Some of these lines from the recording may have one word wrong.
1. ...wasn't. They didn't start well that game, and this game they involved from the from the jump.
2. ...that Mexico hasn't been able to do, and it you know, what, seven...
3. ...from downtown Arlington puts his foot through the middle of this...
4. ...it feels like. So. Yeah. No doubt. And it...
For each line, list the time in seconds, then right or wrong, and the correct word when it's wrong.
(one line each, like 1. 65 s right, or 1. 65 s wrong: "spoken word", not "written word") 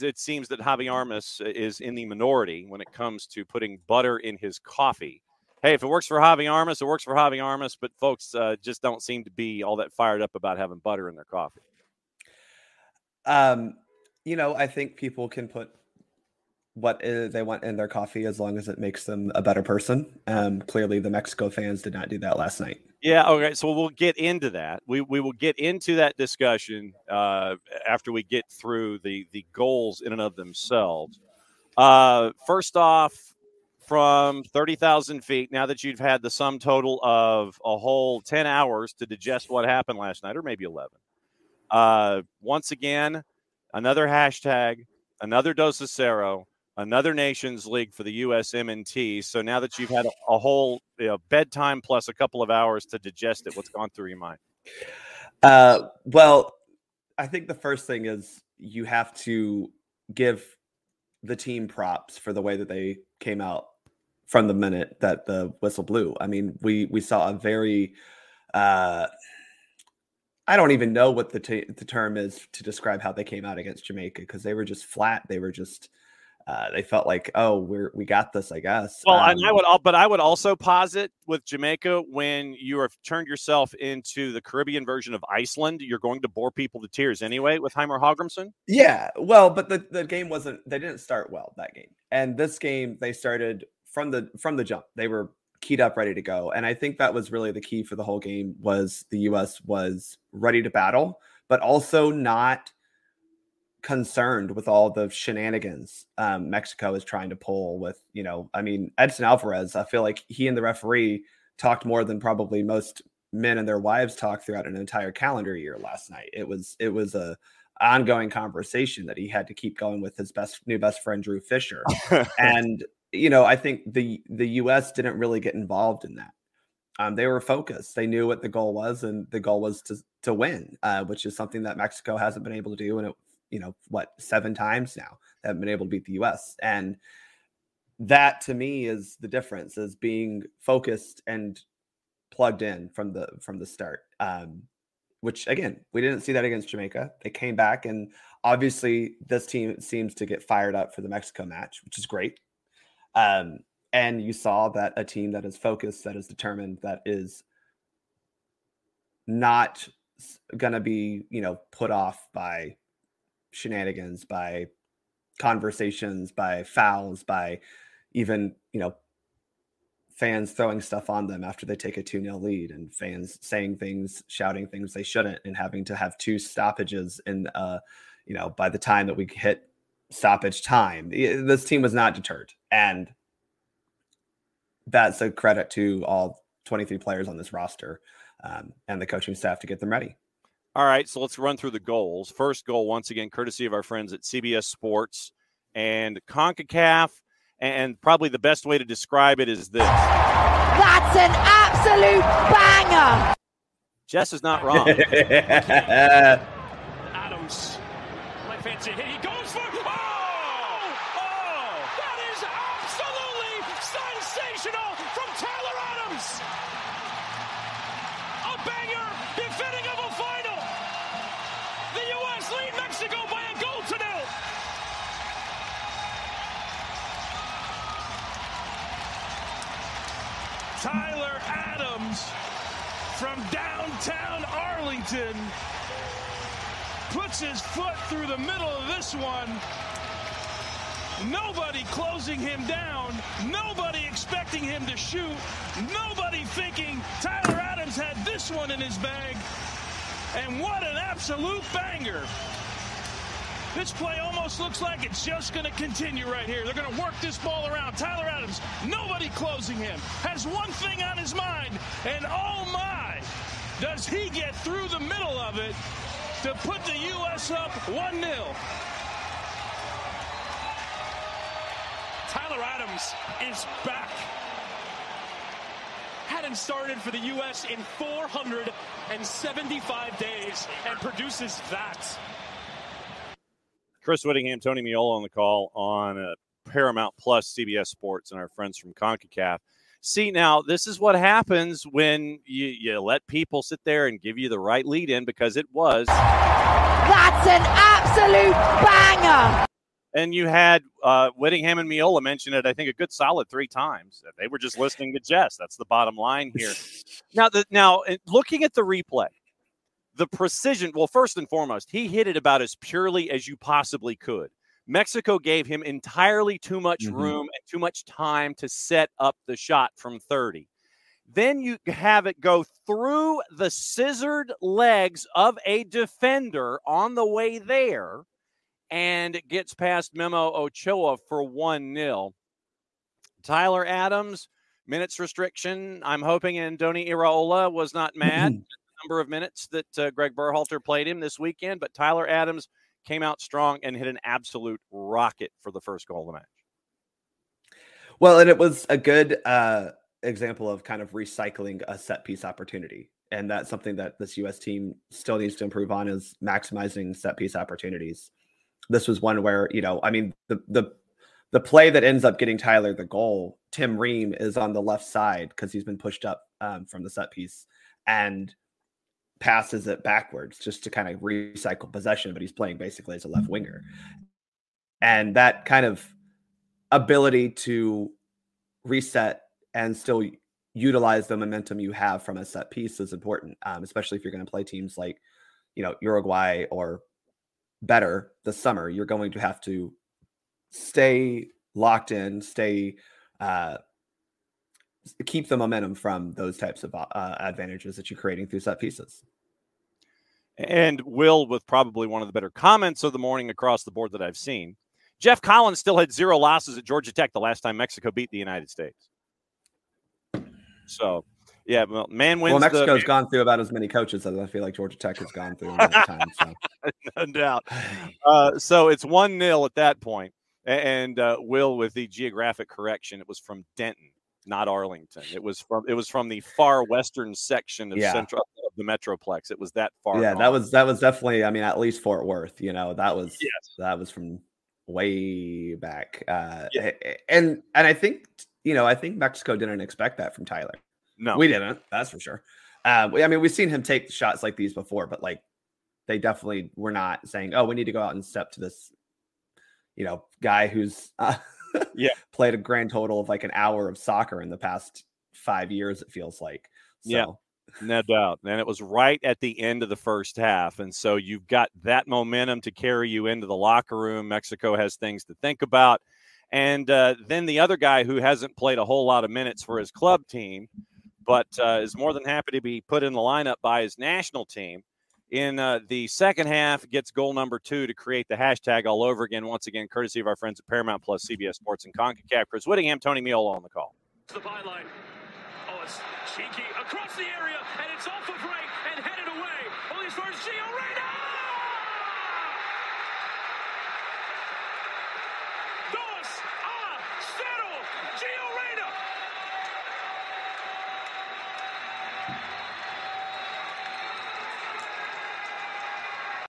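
1. 90 s wrong: "started", not "involved"
2. 131 s right
3. 233 s right
4. 456 s right.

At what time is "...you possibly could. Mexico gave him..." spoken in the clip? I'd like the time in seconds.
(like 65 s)
313 s.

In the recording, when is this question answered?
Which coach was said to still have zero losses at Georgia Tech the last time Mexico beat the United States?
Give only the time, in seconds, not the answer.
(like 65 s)
405 s.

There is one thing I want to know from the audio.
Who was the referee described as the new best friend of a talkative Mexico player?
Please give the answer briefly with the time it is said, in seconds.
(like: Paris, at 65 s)
Drew Fischer, at 121 s.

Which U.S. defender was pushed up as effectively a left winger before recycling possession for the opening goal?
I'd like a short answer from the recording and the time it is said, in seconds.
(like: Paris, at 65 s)
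Tim Ream, at 363 s.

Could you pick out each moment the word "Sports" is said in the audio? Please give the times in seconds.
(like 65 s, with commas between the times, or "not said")
194 s, 287 s, 481 s.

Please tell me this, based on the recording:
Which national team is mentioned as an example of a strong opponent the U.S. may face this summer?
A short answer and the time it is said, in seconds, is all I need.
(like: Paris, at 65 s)
Uruguay, at 386 s.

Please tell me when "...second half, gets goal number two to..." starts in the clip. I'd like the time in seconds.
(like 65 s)
476 s.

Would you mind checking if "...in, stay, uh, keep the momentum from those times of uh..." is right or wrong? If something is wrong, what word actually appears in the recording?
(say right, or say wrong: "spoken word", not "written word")
wrong: "types", not "times".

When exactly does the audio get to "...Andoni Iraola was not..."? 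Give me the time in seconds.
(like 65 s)
336 s.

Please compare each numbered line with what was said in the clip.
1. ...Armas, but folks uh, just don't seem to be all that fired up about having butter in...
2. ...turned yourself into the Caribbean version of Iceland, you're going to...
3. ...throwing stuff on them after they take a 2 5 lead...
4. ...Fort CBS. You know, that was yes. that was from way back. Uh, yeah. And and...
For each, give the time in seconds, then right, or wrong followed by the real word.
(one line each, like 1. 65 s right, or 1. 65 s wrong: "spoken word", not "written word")
1. 7 s right
2. 83 s right
3. 170 s wrong: "0", not "5"
4. 432 s wrong: "Worth", not "CBS".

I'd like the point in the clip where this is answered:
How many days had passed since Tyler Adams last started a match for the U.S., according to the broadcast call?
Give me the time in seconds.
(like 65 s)
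277 s.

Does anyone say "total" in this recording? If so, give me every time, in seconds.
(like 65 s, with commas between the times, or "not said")
36 s, 452 s.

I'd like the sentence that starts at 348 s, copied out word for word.
Well, and it was a good uh, example of kind of recycling a set piece opportunity.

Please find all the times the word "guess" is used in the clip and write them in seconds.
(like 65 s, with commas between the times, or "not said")
78 s.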